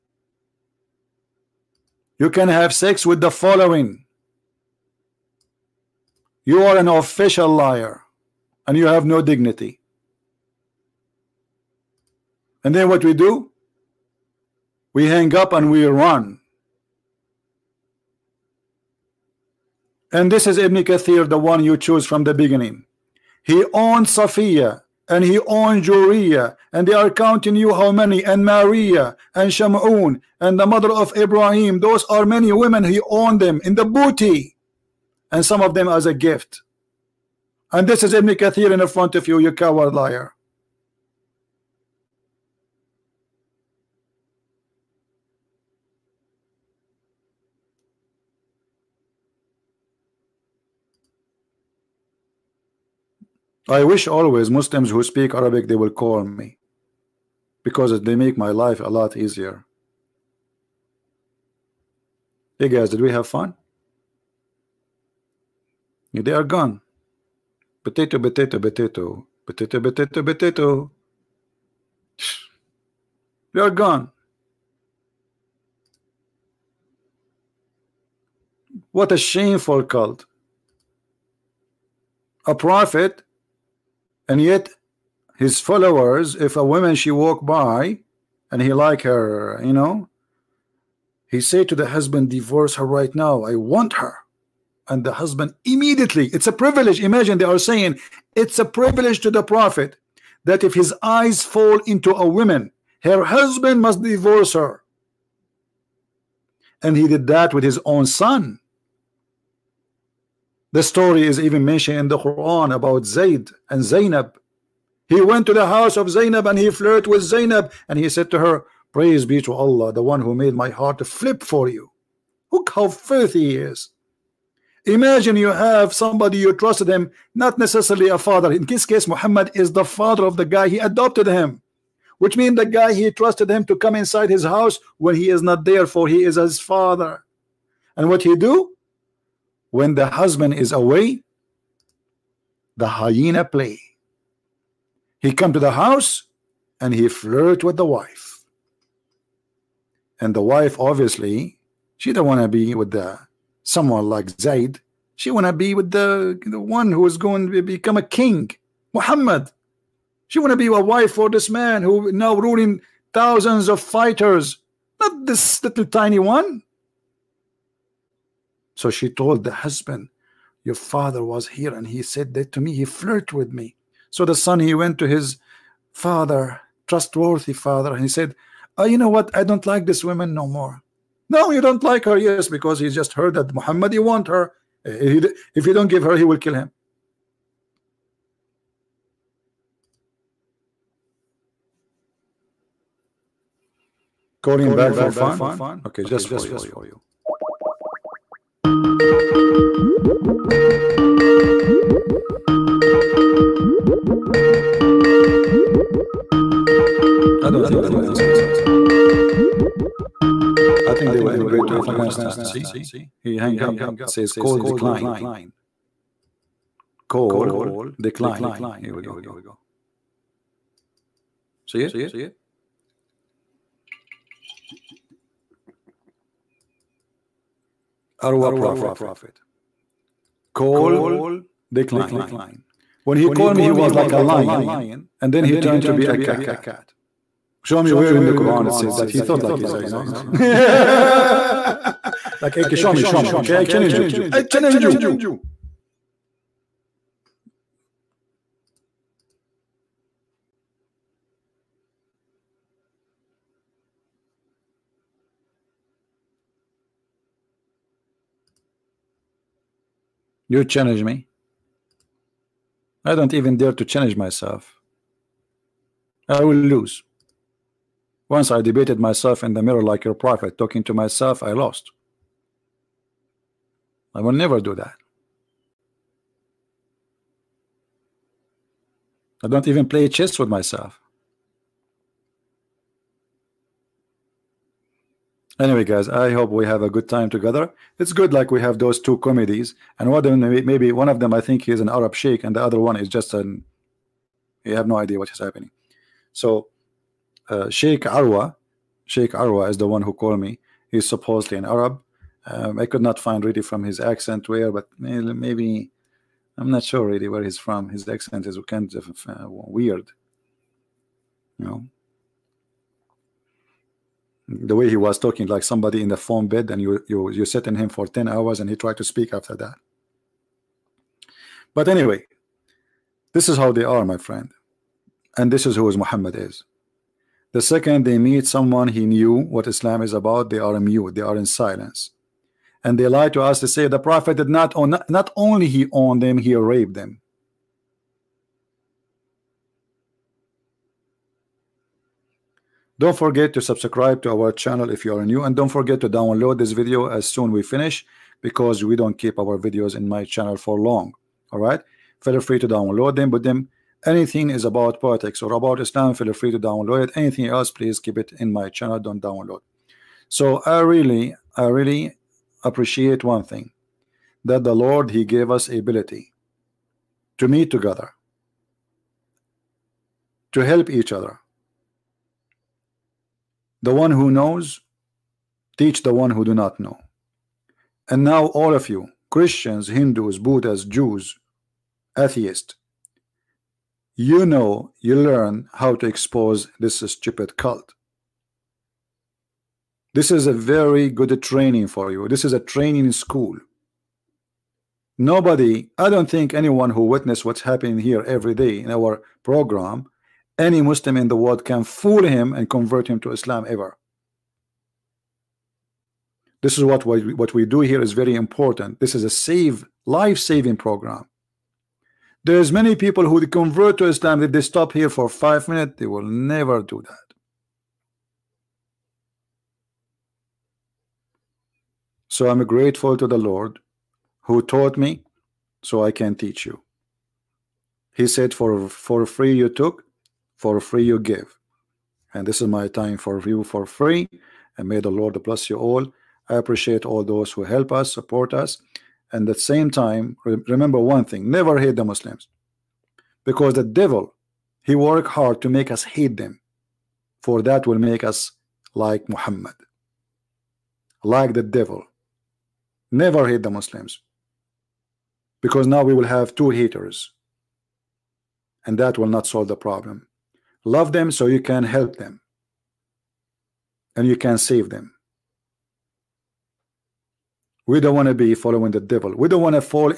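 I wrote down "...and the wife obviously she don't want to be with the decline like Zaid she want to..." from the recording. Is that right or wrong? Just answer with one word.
wrong.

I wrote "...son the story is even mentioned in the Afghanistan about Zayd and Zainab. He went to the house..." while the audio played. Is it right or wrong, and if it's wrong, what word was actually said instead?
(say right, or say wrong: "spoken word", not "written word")
wrong: "Quran", not "Afghanistan".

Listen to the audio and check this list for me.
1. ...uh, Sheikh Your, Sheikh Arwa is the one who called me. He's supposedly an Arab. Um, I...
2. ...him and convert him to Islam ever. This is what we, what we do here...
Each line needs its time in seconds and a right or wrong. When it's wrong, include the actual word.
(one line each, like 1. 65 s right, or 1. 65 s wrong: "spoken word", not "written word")
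1. 297 s wrong: "Arwa", not "Your"
2. 402 s right.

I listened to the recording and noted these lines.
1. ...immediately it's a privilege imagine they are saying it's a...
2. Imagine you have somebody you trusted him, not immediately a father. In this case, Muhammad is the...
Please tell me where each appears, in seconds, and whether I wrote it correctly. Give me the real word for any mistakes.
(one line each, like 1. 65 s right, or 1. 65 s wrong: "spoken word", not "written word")
1. 95 s right
2. 124 s wrong: "necessarily", not "immediately".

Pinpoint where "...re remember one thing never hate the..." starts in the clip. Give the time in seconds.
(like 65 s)
440 s.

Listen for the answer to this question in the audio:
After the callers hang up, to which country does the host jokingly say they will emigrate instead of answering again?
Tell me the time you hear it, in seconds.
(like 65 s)
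211 s.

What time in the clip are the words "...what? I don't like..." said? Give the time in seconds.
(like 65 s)
179 s.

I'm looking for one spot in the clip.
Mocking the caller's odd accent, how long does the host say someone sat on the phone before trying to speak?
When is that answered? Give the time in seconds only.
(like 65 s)
318 s.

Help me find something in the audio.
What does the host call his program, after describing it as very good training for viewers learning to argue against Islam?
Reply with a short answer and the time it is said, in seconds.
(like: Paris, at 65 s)
A training school, at 392 s.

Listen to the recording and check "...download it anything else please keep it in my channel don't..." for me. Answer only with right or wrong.
right.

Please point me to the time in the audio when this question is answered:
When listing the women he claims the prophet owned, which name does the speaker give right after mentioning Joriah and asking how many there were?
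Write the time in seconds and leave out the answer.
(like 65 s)
28 s.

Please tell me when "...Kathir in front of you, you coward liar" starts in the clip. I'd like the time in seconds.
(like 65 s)
38 s.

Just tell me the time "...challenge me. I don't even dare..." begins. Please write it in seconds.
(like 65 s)
260 s.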